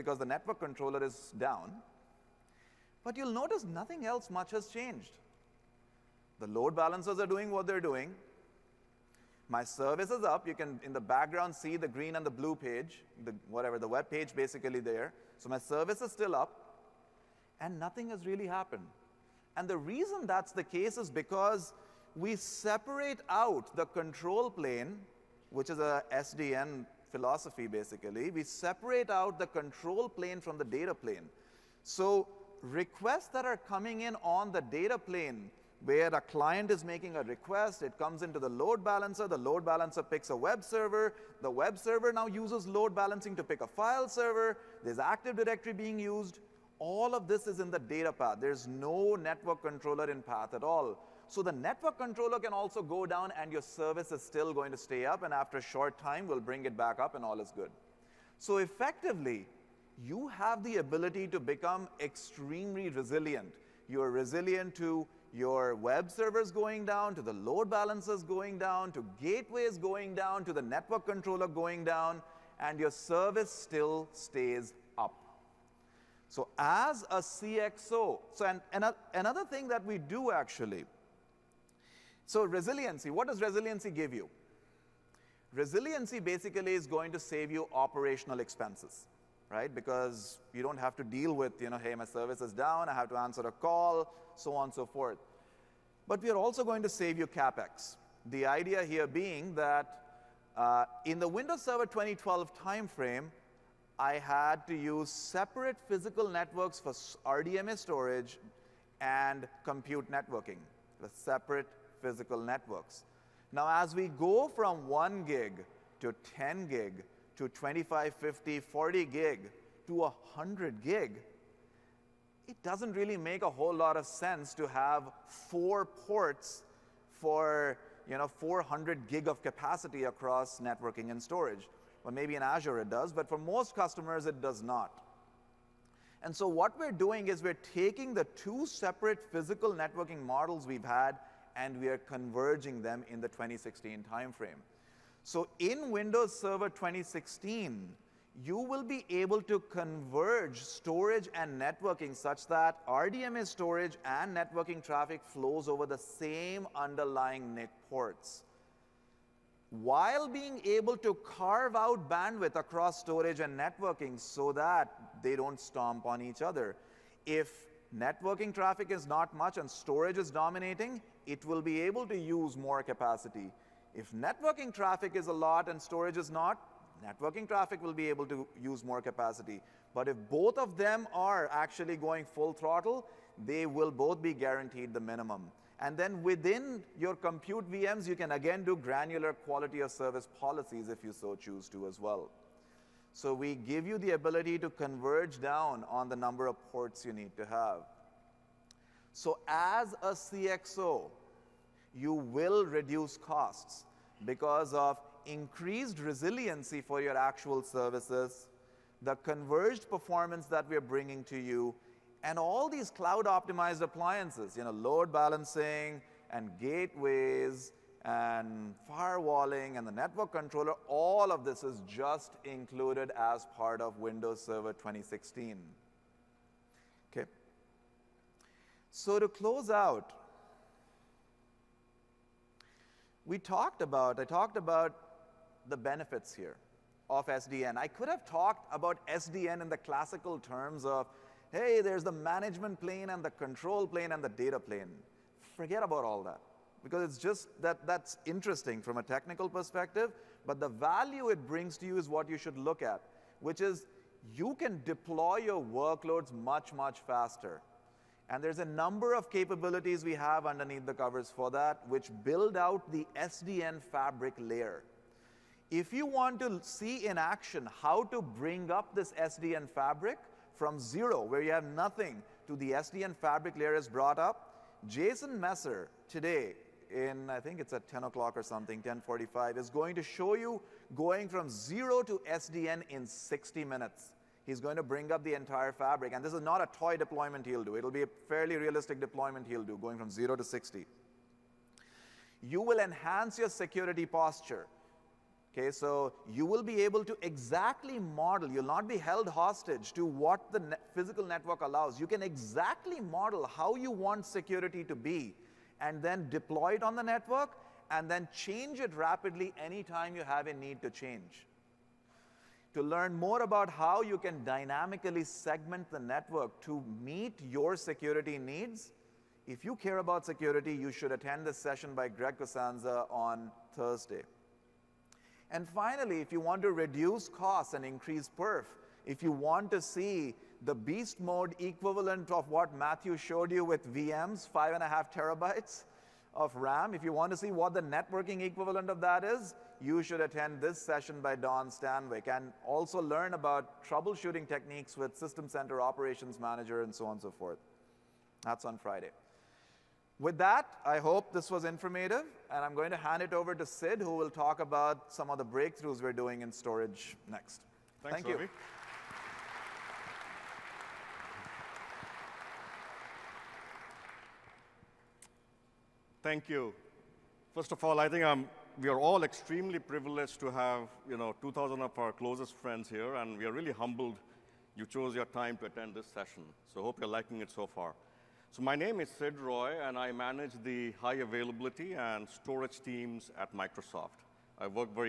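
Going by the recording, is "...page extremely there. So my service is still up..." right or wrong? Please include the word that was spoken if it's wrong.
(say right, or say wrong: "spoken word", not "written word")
wrong: "basically", not "extremely".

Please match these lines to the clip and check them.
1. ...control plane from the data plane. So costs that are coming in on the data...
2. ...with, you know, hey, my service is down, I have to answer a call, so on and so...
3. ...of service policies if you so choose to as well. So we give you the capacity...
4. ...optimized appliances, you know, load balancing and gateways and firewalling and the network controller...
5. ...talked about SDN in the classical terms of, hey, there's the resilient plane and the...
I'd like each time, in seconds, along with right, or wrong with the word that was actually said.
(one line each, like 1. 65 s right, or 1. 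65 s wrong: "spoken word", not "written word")
1. 29 s wrong: "requests", not "costs"
2. 91 s right
3. 189 s wrong: "ability", not "capacity"
4. 213 s right
5. 238 s wrong: "management", not "resilient".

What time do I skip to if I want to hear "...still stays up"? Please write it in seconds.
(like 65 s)
73 s.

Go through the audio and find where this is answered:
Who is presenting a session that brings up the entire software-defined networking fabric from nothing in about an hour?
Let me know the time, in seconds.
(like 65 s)
274 s.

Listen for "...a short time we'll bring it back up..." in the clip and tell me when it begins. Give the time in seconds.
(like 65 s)
55 s.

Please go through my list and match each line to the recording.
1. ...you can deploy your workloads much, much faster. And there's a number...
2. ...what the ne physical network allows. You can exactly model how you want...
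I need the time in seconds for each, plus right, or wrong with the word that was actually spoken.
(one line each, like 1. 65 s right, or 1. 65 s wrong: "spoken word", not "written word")
1. 254 s right
2. 300 s right.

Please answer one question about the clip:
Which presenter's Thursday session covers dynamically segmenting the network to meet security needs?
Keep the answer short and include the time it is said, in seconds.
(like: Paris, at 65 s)
Greg Cusanza, at 322 s.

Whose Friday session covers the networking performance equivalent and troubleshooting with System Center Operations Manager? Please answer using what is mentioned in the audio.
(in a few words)
Don Stanwyck.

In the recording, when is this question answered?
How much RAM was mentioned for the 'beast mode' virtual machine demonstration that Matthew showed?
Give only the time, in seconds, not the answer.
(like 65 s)
334 s.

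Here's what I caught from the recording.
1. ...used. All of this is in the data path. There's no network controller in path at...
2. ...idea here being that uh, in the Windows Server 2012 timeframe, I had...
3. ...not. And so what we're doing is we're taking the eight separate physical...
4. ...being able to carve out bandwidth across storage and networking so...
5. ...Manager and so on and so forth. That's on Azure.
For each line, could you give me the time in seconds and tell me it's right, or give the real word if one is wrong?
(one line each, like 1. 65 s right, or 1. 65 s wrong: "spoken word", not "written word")
1. 45 s right
2. 98 s right
3. 134 s wrong: "two", not "eight"
4. 160 s right
5. 346 s wrong: "Friday", not "Azure".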